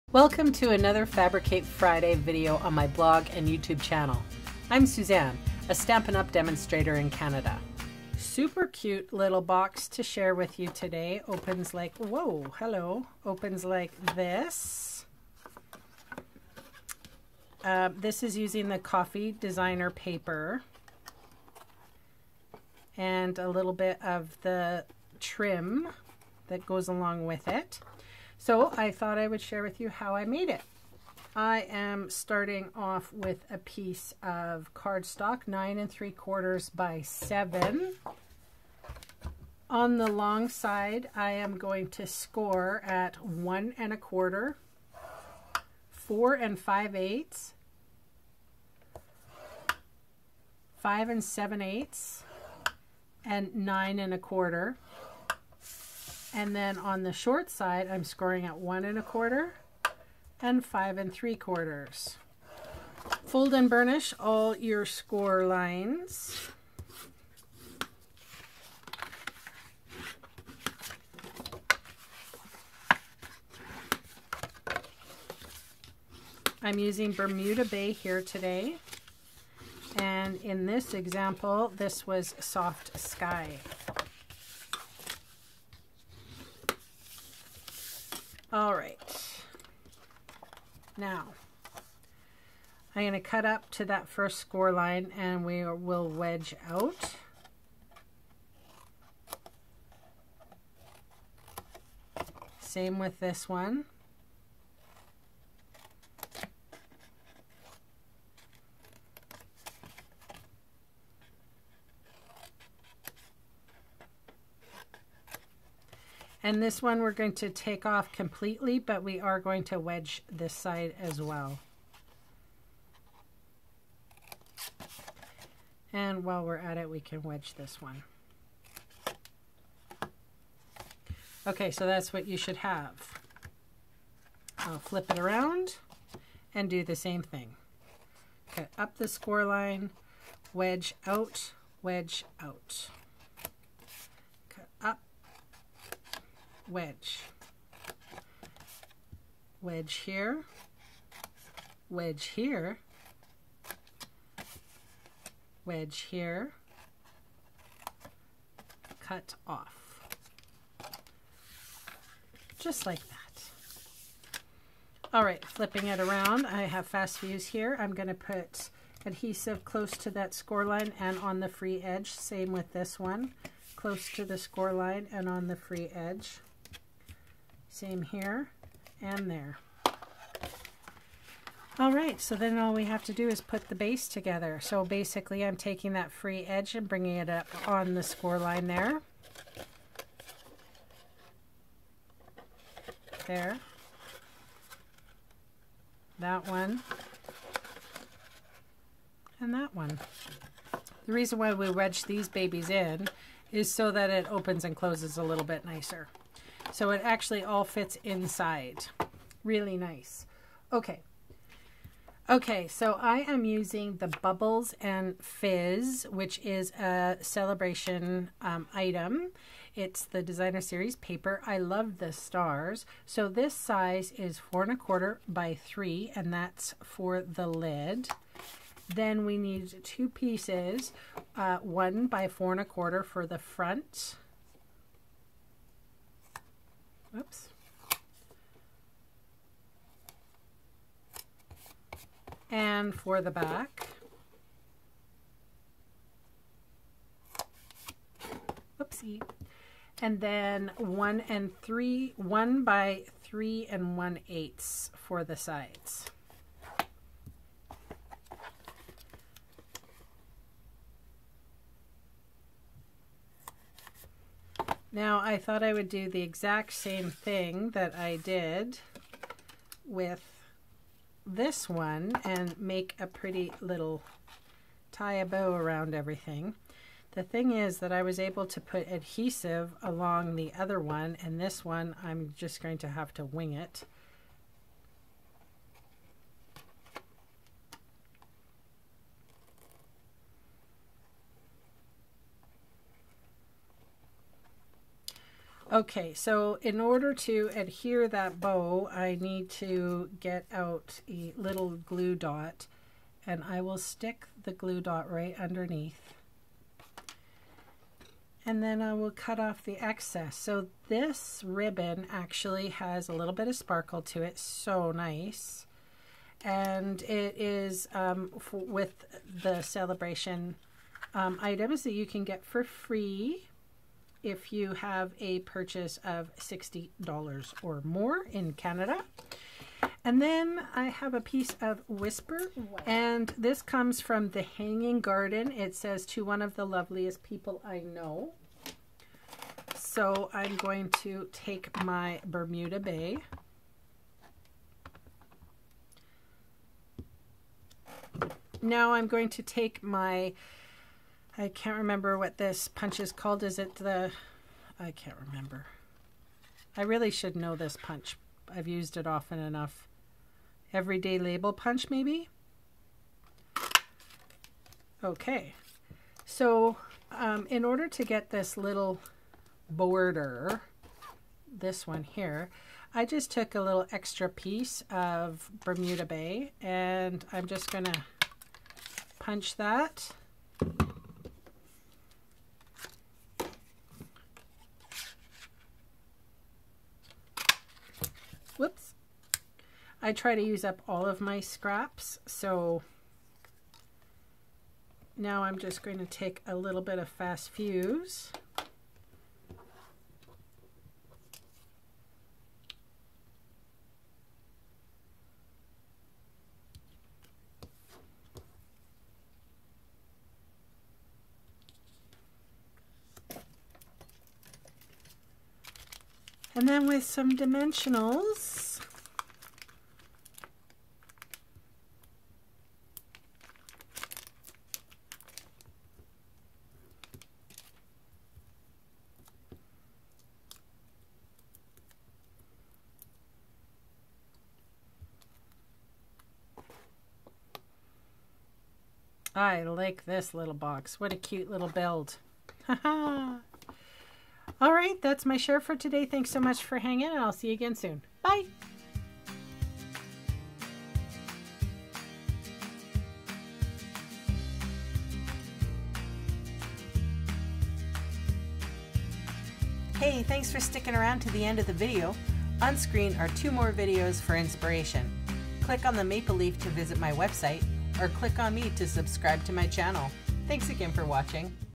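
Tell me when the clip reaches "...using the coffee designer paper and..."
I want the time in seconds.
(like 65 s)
18 s.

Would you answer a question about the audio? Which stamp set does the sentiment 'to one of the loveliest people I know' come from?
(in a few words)
The Hanging Garden.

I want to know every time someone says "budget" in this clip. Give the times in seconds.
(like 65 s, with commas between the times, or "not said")
not said.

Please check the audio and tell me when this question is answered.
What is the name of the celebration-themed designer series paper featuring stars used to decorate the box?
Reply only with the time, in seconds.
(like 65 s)
214 s.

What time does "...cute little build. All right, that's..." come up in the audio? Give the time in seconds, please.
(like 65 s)
441 s.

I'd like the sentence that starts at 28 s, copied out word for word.
So I thought I would share with you how I made it.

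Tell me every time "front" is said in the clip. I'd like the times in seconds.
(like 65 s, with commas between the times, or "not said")
233 s.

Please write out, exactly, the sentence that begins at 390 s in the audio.
I try to use up all of my scraps, so now I'm just going to take a little bit of Fast Fuse.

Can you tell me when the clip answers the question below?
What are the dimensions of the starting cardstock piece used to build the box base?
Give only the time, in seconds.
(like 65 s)
35 s.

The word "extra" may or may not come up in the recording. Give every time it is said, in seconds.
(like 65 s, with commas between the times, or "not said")
373 s.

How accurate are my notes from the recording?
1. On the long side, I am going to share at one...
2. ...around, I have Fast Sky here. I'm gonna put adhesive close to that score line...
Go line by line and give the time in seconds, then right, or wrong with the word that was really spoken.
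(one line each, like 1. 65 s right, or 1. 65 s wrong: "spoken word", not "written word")
1. 39 s wrong: "score", not "share"
2. 165 s wrong: "Fuse", not "Sky".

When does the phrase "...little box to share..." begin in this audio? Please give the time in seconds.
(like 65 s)
9 s.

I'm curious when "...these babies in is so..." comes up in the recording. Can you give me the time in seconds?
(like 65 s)
202 s.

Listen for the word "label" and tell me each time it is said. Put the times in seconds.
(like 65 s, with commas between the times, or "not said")
361 s.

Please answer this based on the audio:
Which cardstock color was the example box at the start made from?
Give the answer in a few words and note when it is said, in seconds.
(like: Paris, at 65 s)
Soft Sky, at 82 s.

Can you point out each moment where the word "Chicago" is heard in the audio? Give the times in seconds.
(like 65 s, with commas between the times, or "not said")
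not said.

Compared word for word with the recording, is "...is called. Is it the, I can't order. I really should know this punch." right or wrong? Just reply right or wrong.
wrong.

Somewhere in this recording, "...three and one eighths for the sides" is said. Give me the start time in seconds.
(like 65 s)
253 s.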